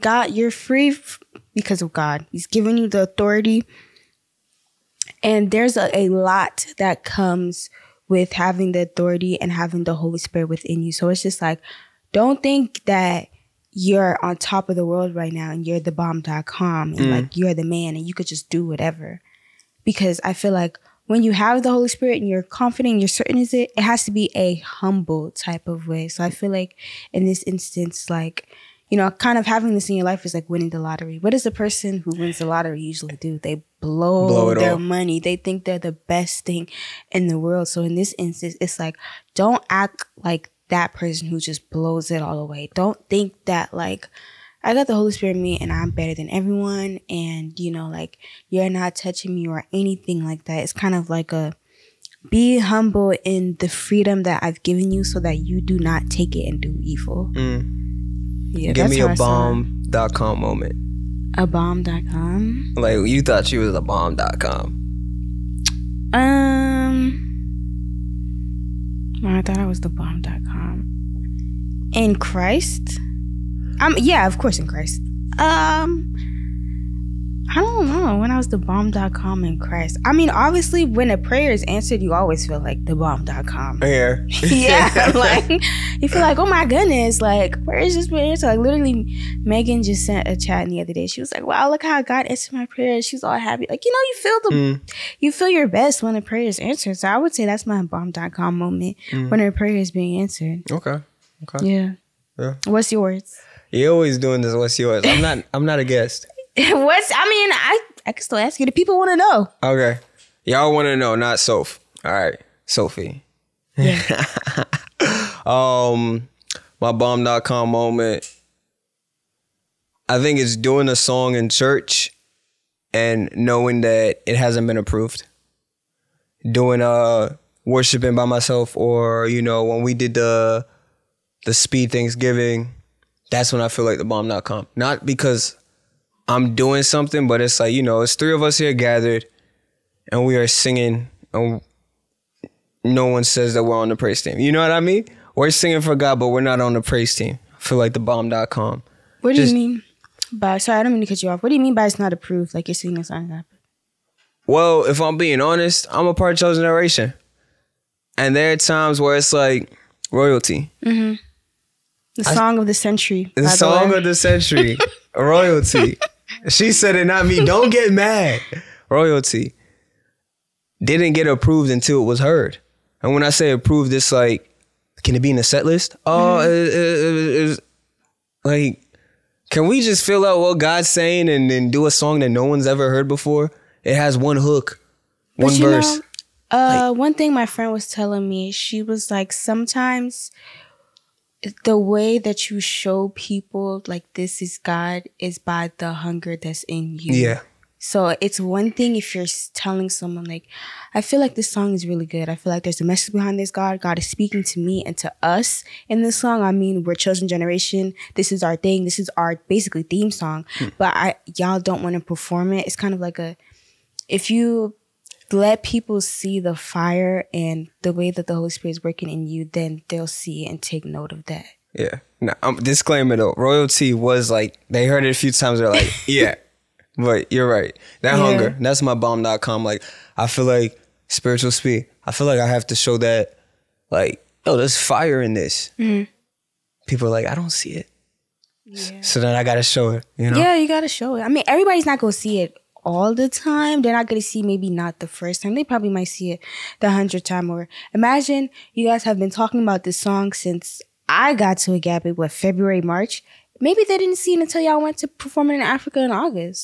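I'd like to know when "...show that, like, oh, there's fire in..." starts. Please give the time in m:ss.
3:52.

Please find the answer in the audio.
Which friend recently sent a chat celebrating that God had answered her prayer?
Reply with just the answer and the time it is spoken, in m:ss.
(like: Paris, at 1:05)
Megan, at 1:29.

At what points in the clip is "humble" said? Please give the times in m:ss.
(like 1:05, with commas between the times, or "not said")
0:24, 0:52.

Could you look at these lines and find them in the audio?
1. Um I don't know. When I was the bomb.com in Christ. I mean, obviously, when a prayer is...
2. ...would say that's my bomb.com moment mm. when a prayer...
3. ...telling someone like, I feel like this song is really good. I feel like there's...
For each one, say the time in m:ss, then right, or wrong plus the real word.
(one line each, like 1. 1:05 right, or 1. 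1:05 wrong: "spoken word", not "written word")
1. 1:15 right
2. 1:37 right
3. 3:19 right.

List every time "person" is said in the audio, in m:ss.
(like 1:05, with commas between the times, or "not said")
0:31, 0:40.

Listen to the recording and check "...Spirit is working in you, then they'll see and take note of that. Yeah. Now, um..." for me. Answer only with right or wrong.
right.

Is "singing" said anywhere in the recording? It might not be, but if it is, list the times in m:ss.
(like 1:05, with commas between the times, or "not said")
2:20, 2:25, 2:32.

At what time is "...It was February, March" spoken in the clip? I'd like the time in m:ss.
4:12.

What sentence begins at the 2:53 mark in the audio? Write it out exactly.
And when I say approved, it's like, can it be in the set list?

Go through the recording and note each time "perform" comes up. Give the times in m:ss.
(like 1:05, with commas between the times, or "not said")
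3:31, 4:15.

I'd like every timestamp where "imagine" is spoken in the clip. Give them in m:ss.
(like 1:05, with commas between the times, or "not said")
4:07.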